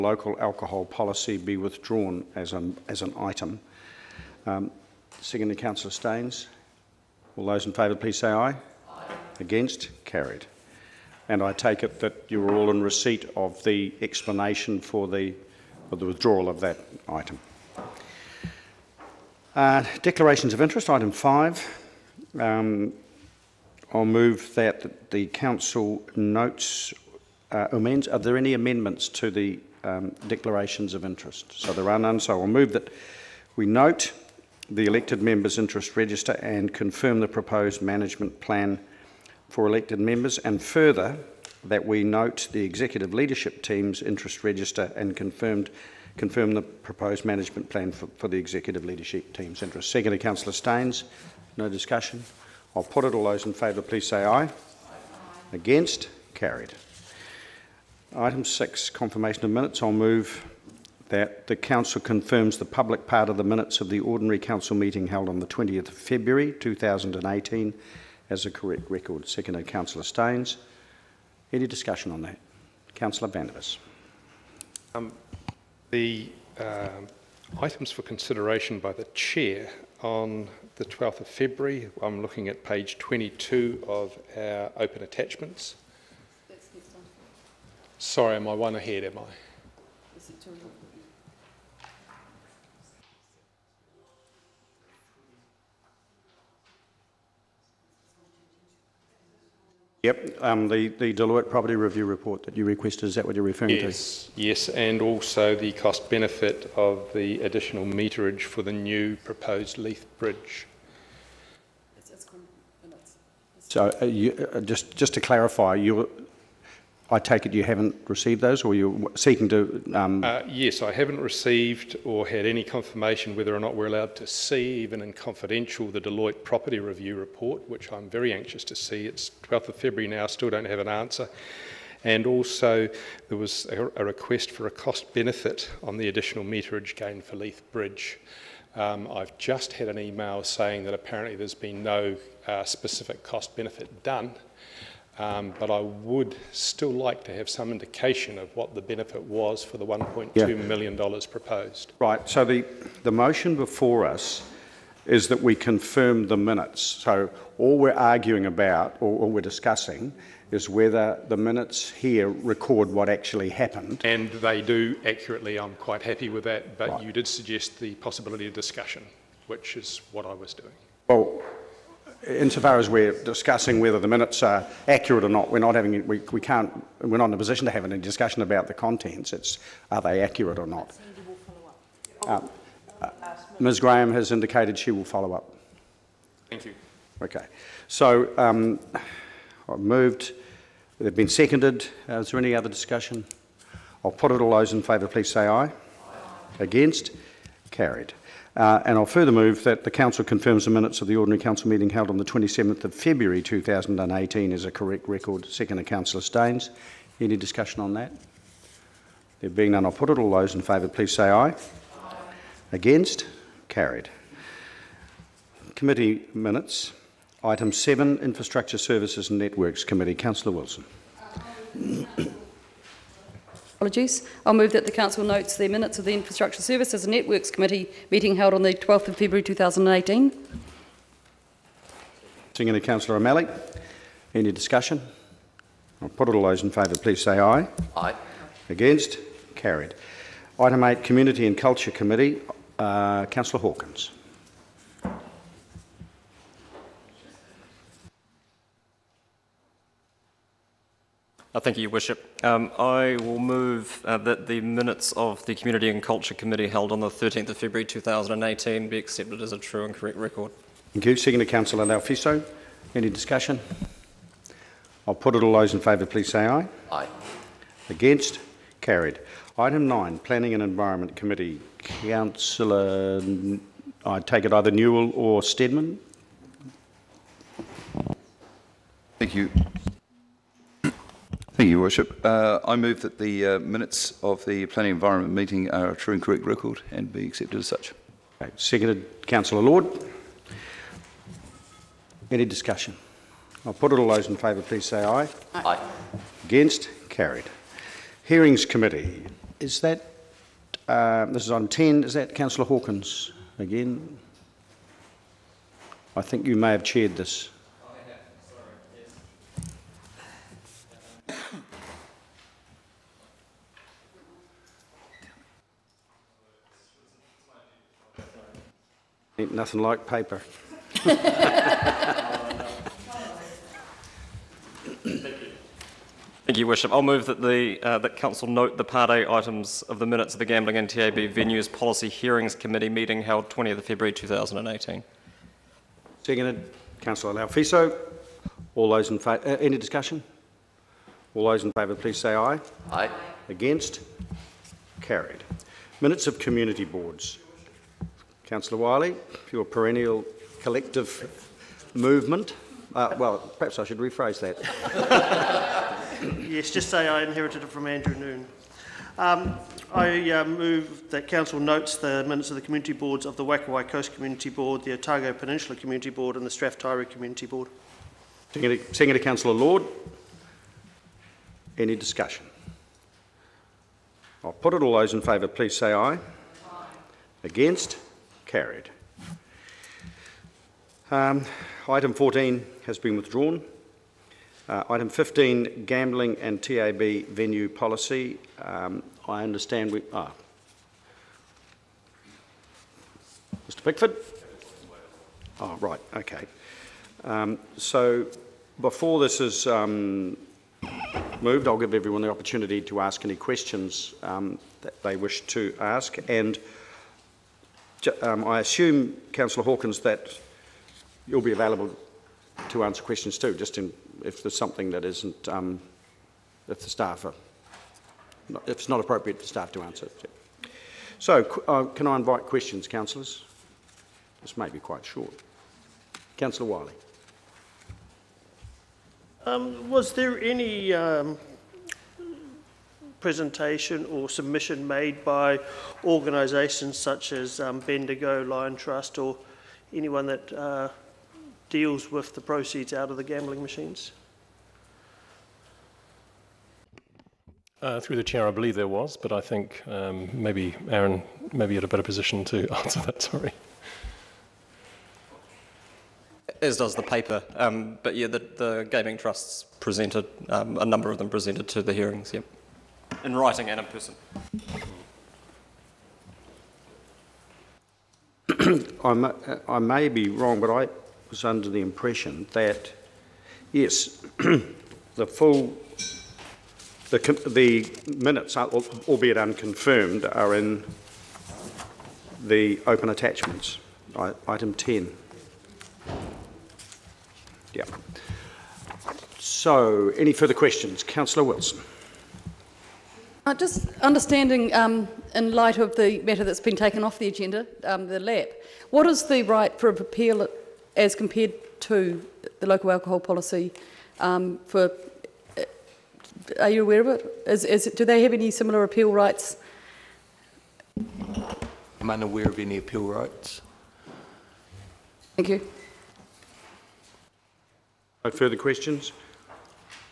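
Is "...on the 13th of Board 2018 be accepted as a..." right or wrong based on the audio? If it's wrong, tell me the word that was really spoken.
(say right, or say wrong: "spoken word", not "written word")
wrong: "February", not "Board".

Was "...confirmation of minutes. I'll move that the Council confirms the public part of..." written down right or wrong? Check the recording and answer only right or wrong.
right.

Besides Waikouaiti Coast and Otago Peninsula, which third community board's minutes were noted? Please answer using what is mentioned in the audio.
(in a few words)
Strath Taieri.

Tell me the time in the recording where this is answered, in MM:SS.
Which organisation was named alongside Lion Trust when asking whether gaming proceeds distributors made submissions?
07:17.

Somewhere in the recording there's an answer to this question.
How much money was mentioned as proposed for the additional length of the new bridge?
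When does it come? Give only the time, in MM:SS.
02:29.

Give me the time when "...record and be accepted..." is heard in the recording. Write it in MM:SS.
04:46.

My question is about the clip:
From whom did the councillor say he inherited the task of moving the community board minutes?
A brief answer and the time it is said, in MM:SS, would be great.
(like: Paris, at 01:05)
Andrew Noone, at 05:57.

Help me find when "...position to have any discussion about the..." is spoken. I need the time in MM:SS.
02:57.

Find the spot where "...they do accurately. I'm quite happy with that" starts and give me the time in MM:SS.
02:44.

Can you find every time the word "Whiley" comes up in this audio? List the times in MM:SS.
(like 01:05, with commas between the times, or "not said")
05:48, 07:06.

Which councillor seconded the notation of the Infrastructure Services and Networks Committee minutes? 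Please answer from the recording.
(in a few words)
Councillor O'Malley.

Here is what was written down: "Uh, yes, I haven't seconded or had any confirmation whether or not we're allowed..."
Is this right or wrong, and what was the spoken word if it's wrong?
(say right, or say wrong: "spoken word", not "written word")
wrong: "received", not "seconded".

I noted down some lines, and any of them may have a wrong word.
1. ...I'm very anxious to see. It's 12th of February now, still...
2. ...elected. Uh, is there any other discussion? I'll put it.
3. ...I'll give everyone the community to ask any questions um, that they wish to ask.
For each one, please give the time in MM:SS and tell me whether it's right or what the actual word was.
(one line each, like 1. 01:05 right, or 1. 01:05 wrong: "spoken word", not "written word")
1. 02:07 right
2. 03:11 wrong: "seconded", not "elected"
3. 06:41 wrong: "opportunity", not "community".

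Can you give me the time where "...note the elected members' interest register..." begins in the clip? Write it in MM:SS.
00:33.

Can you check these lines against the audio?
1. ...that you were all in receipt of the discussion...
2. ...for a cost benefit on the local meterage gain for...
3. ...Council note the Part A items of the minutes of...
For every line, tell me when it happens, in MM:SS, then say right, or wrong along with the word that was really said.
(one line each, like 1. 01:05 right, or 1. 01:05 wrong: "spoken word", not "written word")
1. 00:11 wrong: "explanation", not "discussion"
2. 02:14 wrong: "additional", not "local"
3. 05:28 right.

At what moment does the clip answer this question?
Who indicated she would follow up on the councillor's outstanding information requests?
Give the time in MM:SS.
03:03.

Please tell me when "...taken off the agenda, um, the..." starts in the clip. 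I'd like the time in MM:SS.
08:16.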